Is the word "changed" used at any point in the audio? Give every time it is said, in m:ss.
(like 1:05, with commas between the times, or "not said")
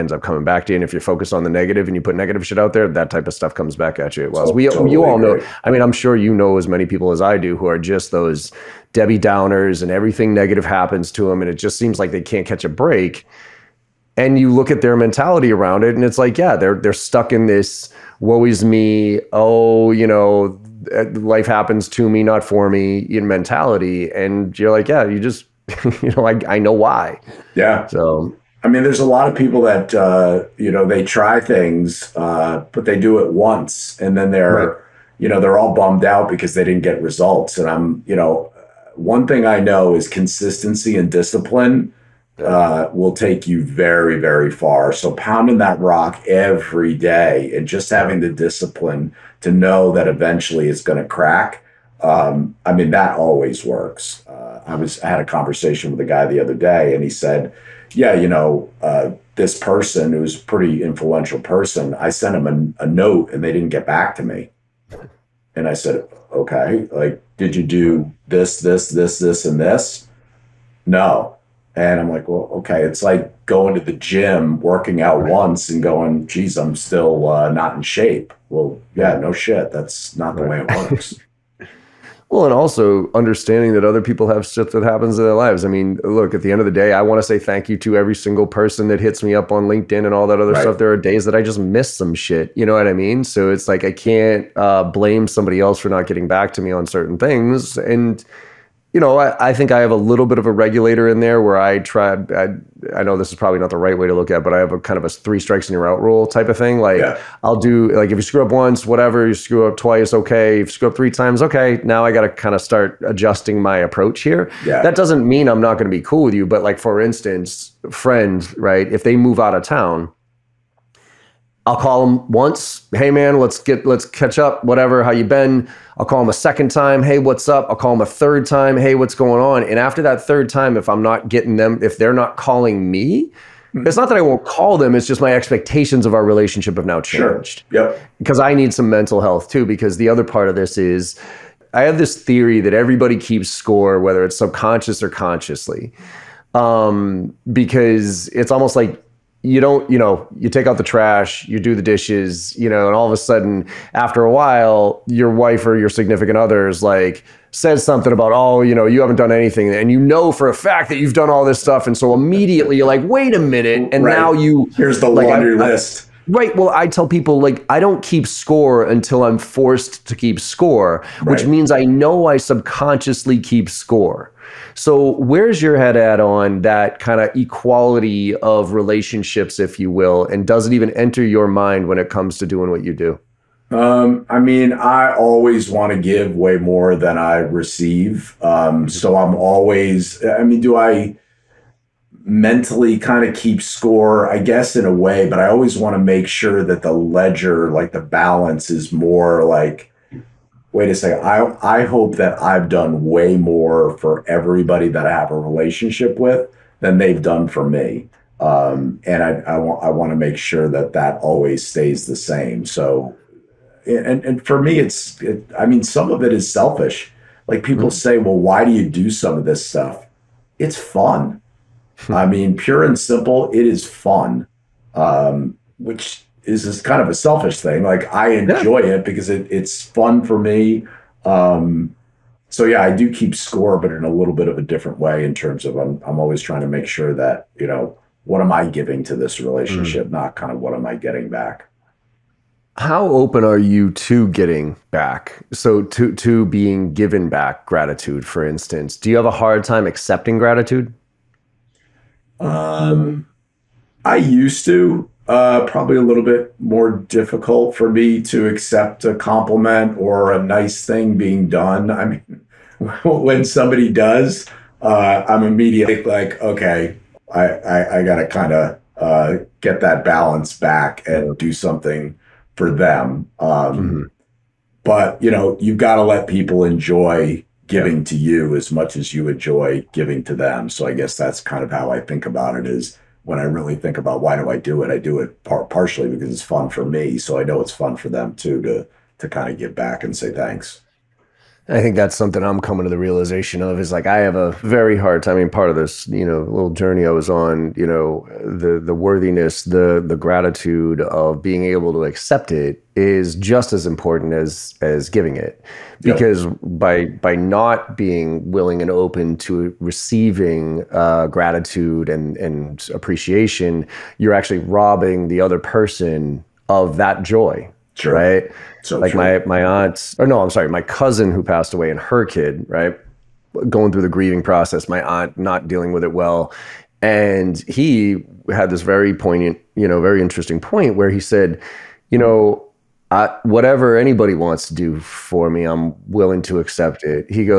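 2:16.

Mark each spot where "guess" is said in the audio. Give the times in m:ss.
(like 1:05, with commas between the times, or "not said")
3:14, 4:40.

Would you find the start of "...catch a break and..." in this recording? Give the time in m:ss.
0:12.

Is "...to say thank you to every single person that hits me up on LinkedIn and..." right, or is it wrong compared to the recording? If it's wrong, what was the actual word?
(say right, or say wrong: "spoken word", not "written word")
right.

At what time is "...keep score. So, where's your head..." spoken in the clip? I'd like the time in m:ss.
2:53.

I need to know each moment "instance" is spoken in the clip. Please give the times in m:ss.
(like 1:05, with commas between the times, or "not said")
1:56, 4:08.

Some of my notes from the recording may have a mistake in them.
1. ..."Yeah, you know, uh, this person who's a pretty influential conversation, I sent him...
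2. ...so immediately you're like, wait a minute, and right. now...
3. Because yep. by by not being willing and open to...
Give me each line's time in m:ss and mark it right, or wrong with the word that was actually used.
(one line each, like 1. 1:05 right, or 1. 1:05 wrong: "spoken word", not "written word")
1. 0:57 wrong: "person", not "conversation"
2. 2:41 right
3. 5:06 right.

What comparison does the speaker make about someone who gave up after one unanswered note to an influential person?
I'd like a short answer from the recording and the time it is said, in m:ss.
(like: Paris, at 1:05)
Going to the gym, at 1:13.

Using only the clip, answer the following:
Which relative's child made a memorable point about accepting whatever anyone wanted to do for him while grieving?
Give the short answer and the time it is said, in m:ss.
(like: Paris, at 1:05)
Cousin, at 5:20.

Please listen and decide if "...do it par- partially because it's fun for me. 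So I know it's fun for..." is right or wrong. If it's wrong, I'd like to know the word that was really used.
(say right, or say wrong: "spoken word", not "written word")
right.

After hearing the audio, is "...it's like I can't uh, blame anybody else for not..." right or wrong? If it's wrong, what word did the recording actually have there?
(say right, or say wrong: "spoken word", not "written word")
wrong: "somebody", not "anybody".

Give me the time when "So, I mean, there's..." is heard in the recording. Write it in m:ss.
0:27.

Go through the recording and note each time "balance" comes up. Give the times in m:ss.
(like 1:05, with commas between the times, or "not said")
3:18, 4:30.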